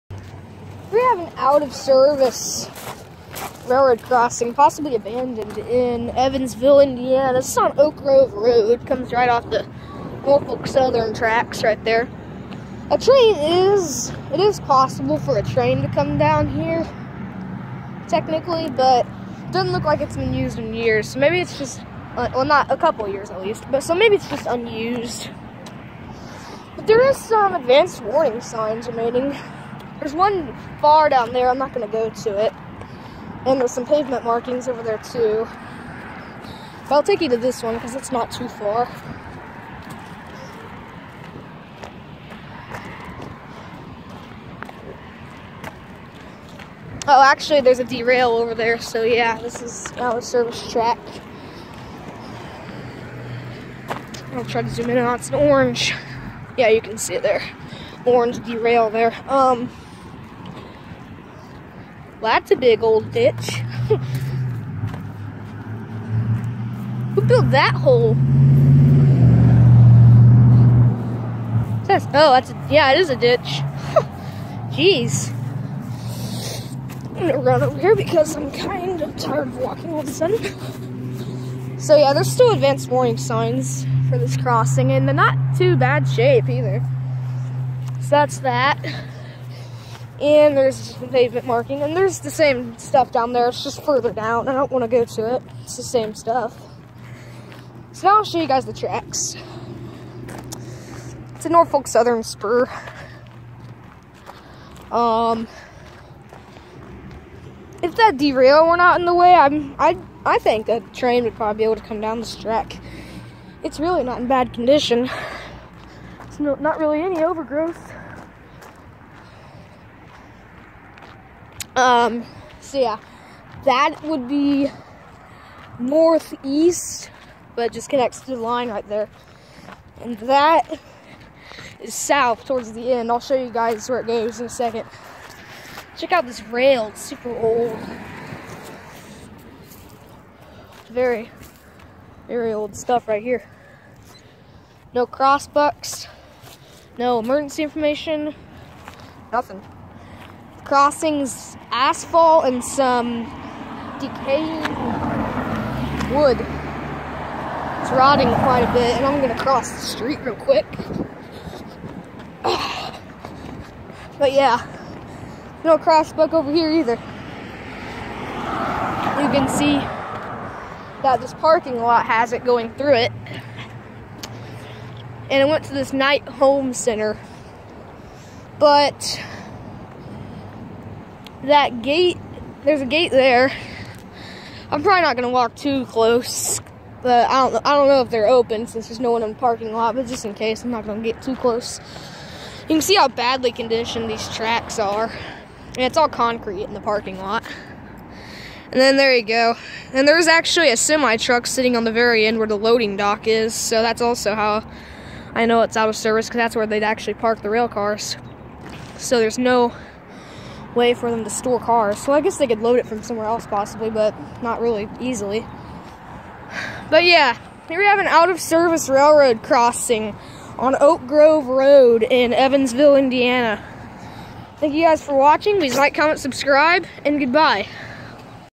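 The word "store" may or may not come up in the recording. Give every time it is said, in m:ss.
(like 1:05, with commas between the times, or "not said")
3:31.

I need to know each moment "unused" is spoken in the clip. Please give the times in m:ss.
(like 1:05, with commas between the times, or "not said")
0:24.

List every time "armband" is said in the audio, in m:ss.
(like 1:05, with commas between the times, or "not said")
not said.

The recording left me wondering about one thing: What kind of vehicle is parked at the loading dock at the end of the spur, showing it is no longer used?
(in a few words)
Semi truck.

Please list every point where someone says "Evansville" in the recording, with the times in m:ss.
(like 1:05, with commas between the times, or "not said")
0:06, 3:42.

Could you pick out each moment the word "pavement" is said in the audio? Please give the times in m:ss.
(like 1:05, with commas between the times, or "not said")
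0:33, 1:31.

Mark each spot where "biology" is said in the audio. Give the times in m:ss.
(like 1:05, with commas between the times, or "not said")
not said.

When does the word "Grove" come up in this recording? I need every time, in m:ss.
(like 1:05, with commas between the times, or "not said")
0:07, 3:41.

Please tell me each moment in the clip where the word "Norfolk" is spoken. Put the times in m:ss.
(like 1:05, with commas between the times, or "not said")
0:10, 1:41.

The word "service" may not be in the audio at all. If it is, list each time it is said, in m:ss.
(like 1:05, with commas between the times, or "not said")
0:01, 0:50, 3:25, 3:38.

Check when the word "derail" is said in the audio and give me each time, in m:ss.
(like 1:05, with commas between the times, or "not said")
0:47, 0:58, 1:48.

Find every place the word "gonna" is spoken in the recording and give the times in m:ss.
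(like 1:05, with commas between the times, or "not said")
1:17, 2:39, 3:05, 3:10.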